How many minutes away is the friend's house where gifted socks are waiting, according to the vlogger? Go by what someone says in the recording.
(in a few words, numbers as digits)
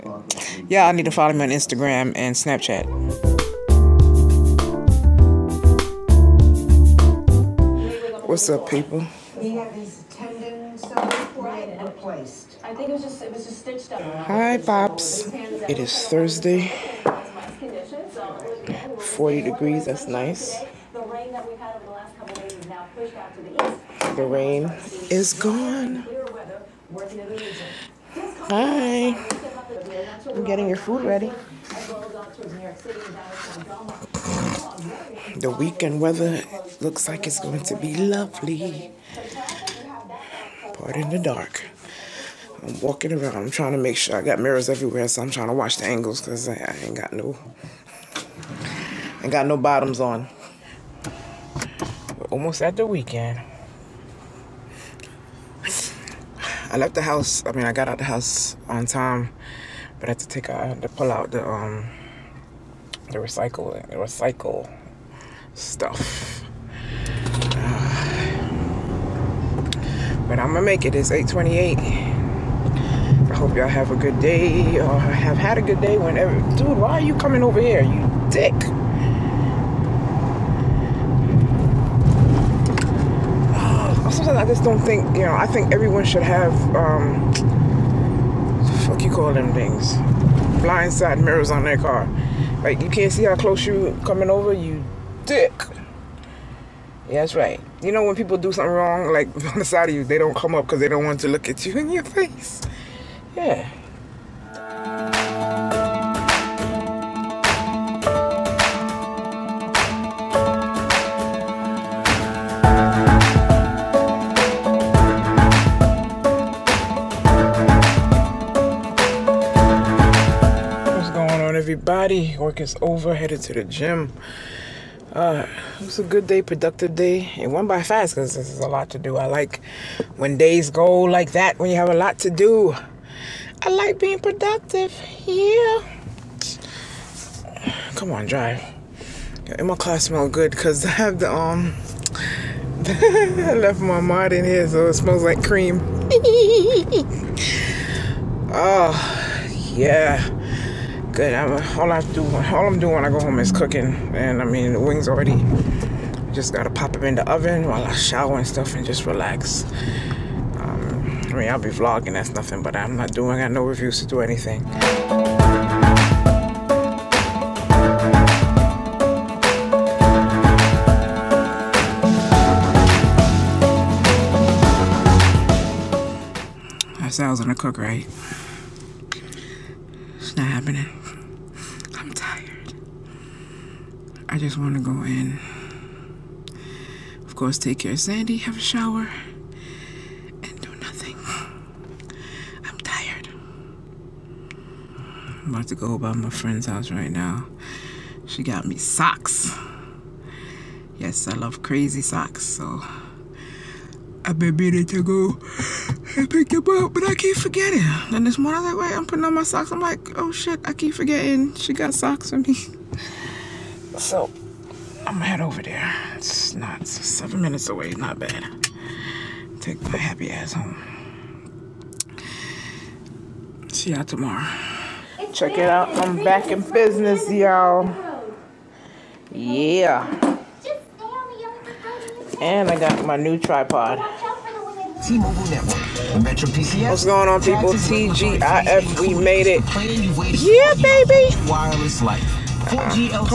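7.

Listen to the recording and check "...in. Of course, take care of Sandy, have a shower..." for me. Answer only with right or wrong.
right.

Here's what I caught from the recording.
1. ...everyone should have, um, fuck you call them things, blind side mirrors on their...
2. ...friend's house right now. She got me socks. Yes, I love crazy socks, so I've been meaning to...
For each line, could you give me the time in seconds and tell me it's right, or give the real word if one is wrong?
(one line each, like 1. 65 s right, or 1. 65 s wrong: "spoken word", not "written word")
1. 85 s right
2. 196 s right.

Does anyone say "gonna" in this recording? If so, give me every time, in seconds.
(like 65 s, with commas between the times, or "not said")
70 s, 177 s, 215 s.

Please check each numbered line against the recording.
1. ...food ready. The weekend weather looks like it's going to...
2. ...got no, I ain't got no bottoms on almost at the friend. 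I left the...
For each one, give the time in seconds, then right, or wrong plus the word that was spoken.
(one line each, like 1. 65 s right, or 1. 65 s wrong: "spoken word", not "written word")
1. 30 s right
2. 46 s wrong: "weekend", not "friend".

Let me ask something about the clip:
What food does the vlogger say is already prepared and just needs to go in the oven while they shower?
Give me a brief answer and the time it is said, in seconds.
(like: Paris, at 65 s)
Wings, at 154 s.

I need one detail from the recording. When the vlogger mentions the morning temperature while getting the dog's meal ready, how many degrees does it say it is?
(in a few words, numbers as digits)
40.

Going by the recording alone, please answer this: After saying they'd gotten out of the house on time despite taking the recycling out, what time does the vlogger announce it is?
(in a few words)
8:28.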